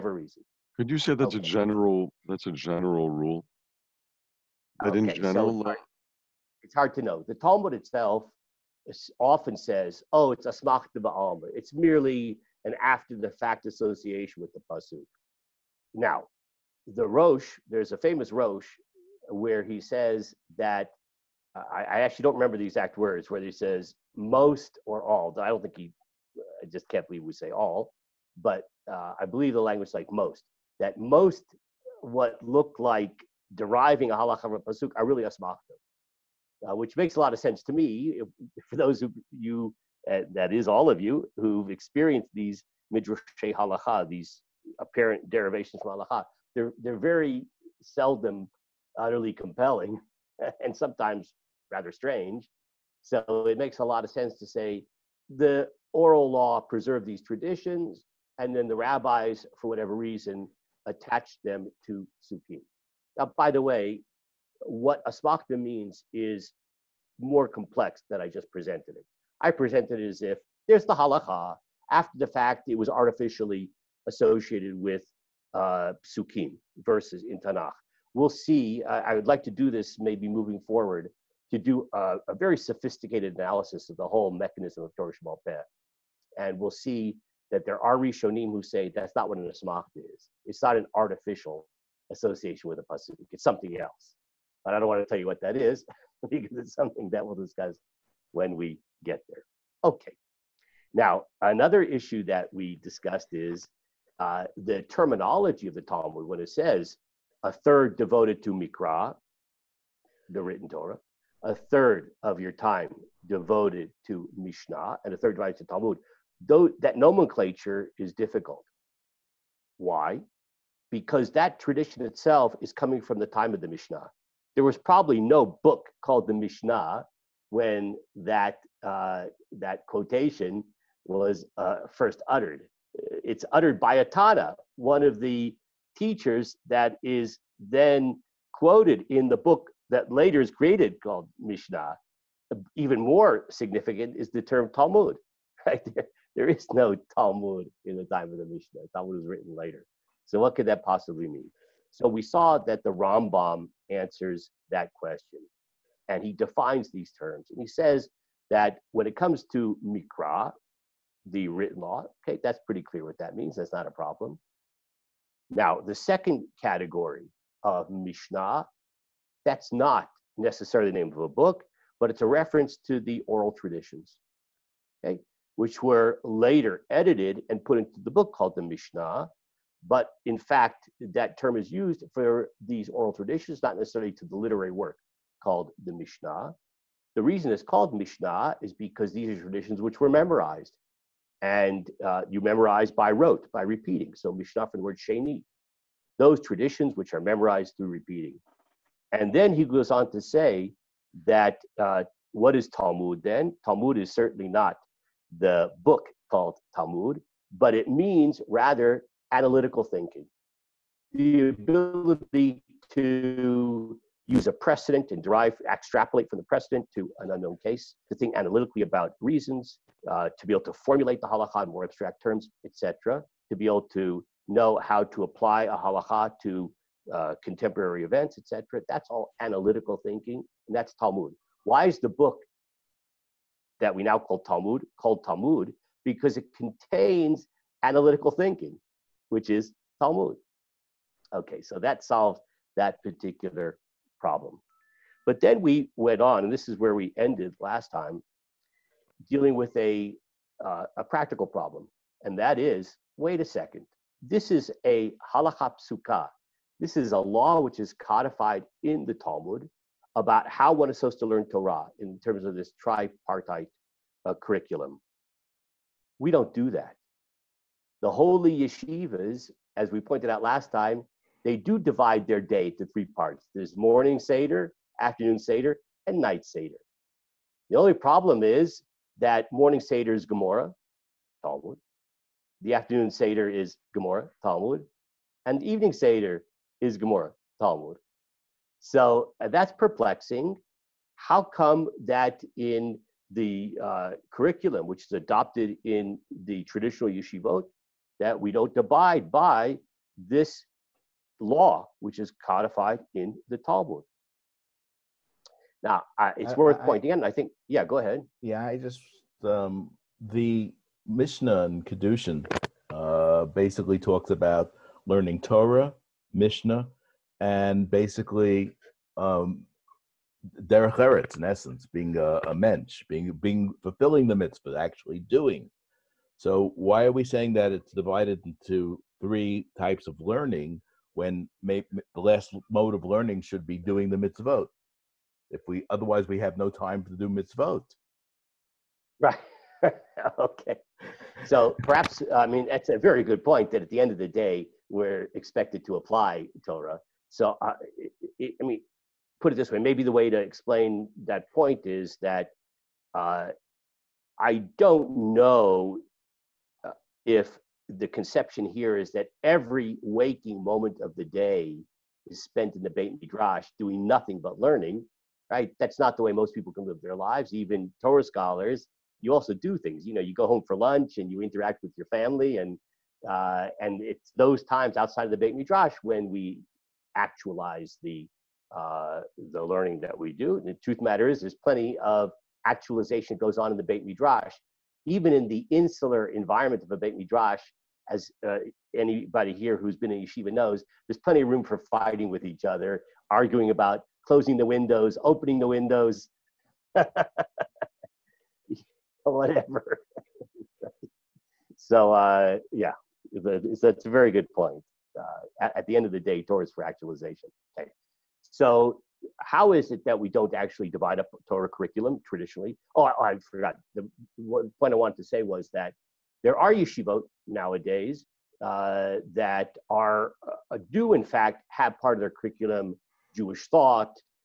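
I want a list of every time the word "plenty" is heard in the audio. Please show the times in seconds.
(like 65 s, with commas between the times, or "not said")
381 s, 391 s.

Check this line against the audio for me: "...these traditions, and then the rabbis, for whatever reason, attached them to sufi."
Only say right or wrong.
right.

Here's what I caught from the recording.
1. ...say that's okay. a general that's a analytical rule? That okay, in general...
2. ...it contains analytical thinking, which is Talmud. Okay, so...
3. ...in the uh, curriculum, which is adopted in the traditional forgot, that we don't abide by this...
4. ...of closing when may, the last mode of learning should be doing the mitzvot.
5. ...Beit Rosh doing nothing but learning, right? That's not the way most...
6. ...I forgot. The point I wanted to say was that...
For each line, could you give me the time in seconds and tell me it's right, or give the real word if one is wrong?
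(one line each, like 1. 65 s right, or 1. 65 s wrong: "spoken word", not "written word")
1. 0 s wrong: "general", not "analytical"
2. 236 s right
3. 292 s wrong: "yeshivot", not "forgot"
4. 330 s wrong: "learning", not "closing"
5. 362 s wrong: "Midrash", not "Rosh"
6. 413 s right.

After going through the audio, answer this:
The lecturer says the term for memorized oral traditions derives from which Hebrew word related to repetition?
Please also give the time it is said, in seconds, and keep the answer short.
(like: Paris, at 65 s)
Sheni, at 194 s.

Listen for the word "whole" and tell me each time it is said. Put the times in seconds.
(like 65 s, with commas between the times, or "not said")
84 s.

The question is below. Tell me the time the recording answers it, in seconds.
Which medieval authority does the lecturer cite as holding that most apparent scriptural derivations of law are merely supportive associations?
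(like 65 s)
16 s.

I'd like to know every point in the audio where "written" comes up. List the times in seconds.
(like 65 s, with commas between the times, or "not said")
110 s, 149 s, 161 s.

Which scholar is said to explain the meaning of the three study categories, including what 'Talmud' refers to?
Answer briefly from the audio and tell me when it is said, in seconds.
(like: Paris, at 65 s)
Rambam, at 152 s.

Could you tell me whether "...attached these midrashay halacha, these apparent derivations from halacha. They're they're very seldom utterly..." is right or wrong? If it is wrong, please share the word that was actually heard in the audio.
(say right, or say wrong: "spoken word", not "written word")
wrong: "experienced", not "attached".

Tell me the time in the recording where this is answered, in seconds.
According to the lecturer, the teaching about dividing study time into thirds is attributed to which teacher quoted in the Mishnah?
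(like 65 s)
134 s.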